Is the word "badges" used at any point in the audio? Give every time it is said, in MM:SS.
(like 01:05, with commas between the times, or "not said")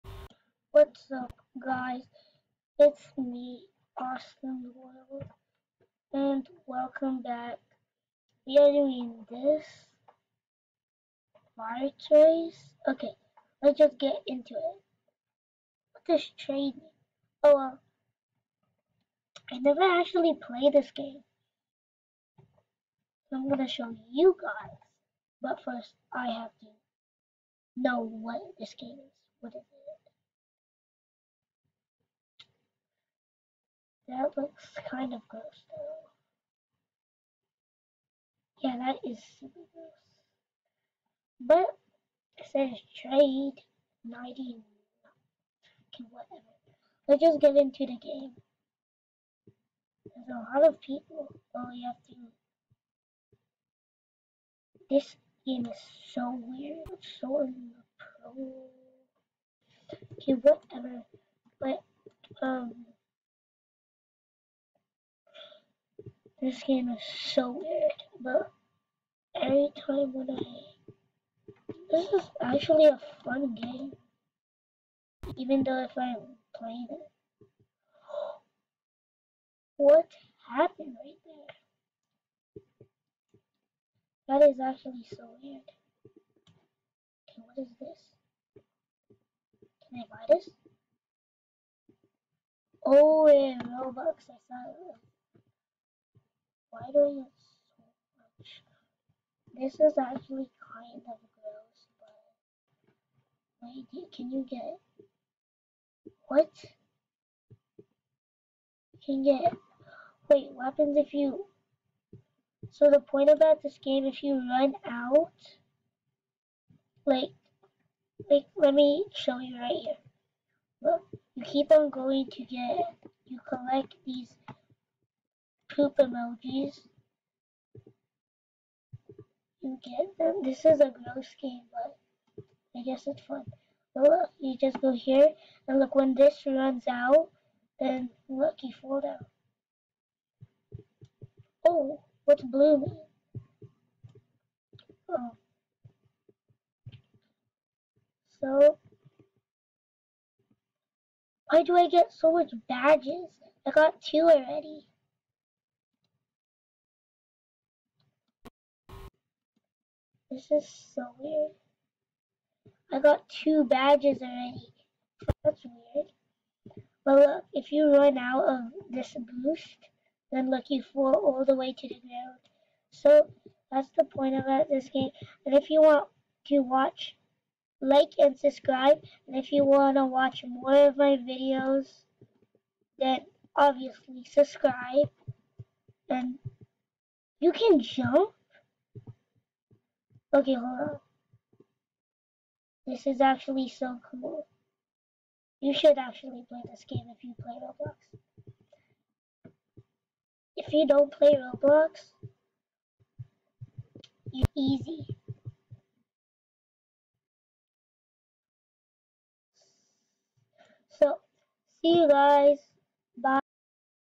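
02:32, 02:43.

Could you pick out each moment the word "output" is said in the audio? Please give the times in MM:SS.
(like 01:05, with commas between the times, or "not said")
not said.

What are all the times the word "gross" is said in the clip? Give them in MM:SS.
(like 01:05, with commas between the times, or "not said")
00:35, 00:39, 01:41, 02:10.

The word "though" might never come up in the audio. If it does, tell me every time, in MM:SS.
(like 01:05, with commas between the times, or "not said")
00:35, 01:15.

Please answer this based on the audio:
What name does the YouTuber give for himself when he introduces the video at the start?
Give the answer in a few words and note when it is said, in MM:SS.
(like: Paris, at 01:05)
Austin Royal, at 00:04.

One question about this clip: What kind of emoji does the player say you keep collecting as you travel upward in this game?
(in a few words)
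poop emojis.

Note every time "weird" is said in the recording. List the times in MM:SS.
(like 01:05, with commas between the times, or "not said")
00:56, 01:07, 01:25, 02:41, 02:45.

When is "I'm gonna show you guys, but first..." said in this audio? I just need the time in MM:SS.
00:23.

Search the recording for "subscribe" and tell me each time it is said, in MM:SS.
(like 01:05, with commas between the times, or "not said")
02:58, 03:04.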